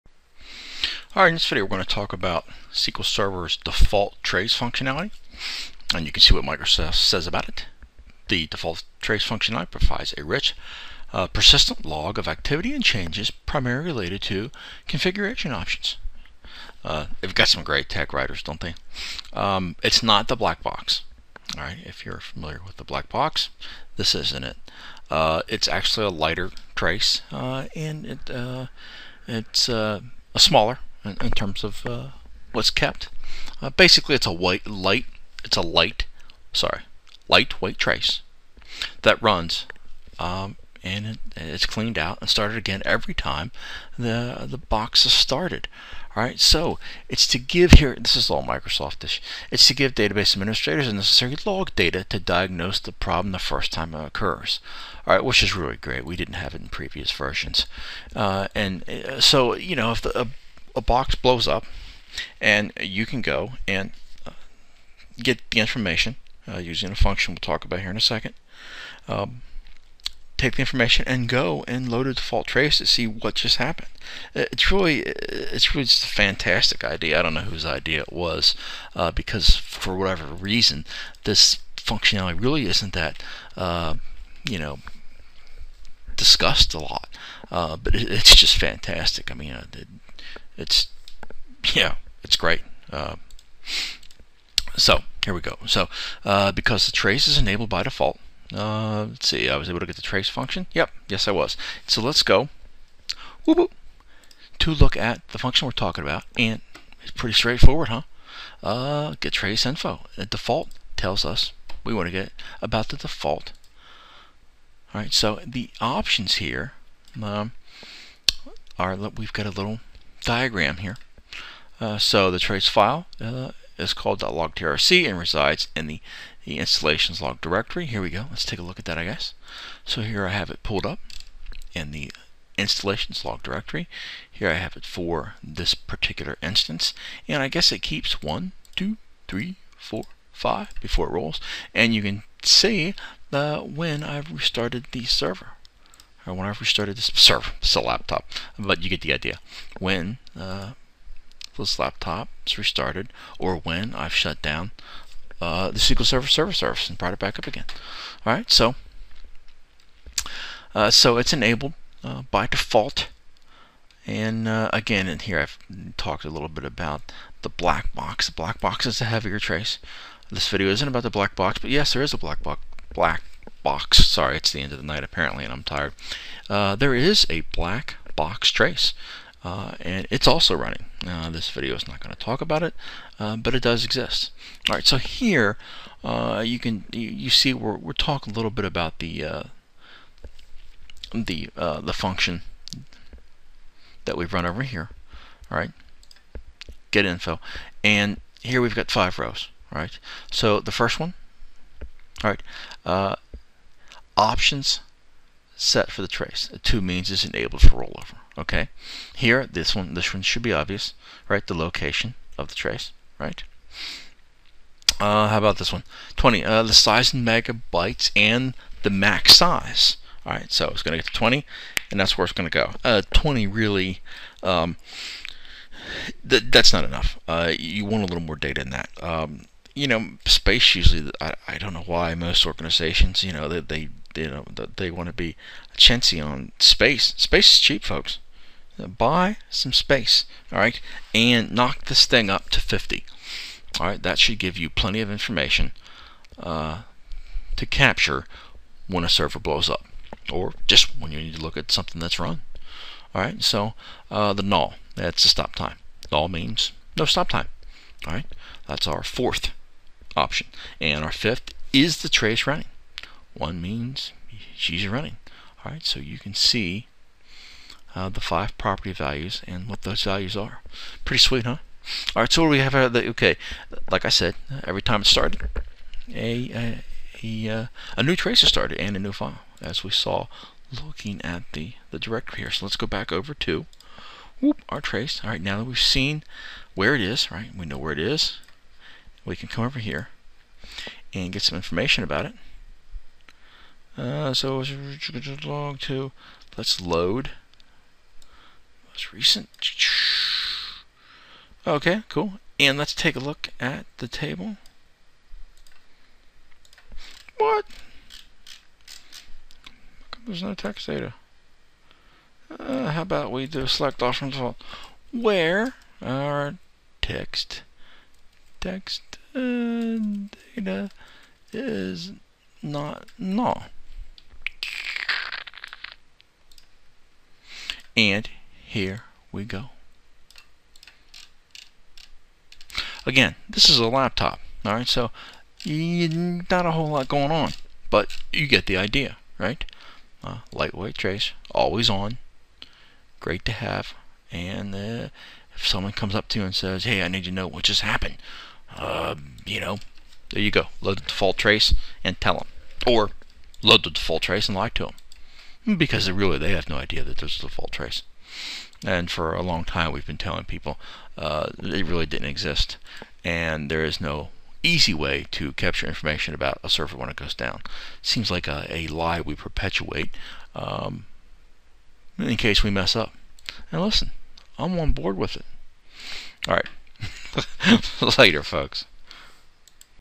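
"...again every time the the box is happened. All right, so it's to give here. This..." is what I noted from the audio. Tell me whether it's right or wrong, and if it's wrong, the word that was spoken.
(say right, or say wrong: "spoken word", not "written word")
wrong: "started", not "happened".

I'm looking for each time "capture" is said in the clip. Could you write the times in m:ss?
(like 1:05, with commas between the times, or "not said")
4:07, 6:05.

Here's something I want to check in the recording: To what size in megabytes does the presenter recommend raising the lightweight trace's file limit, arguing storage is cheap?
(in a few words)
50.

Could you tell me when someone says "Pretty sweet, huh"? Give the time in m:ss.
4:31.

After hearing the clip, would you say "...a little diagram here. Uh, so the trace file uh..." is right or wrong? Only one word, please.
right.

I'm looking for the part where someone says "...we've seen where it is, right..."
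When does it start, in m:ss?
4:45.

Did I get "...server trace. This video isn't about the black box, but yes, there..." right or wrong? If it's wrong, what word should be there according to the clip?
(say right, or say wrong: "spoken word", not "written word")
wrong: "heavier", not "server".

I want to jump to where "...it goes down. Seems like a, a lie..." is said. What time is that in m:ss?
6:07.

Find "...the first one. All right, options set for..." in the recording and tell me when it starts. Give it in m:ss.
3:20.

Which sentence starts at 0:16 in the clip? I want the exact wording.
Uh, they've got some great tech writers, don't they?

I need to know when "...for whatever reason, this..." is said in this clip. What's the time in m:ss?
1:19.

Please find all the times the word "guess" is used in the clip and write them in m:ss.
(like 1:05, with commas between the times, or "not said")
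2:09, 2:17.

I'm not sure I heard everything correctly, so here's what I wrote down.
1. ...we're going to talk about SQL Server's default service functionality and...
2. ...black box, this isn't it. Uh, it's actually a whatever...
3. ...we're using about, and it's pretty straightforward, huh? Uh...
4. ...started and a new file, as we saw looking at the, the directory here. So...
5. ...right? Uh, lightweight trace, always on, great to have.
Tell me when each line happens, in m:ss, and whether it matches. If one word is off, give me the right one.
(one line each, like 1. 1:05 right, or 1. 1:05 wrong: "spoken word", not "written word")
1. 0:01 wrong: "trace", not "service"
2. 0:22 wrong: "lighter", not "whatever"
3. 1:45 wrong: "talking", not "using"
4. 4:38 right
5. 5:39 right.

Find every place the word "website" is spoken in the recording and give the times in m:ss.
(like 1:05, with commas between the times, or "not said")
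not said.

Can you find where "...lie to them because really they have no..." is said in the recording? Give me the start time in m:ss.
5:54.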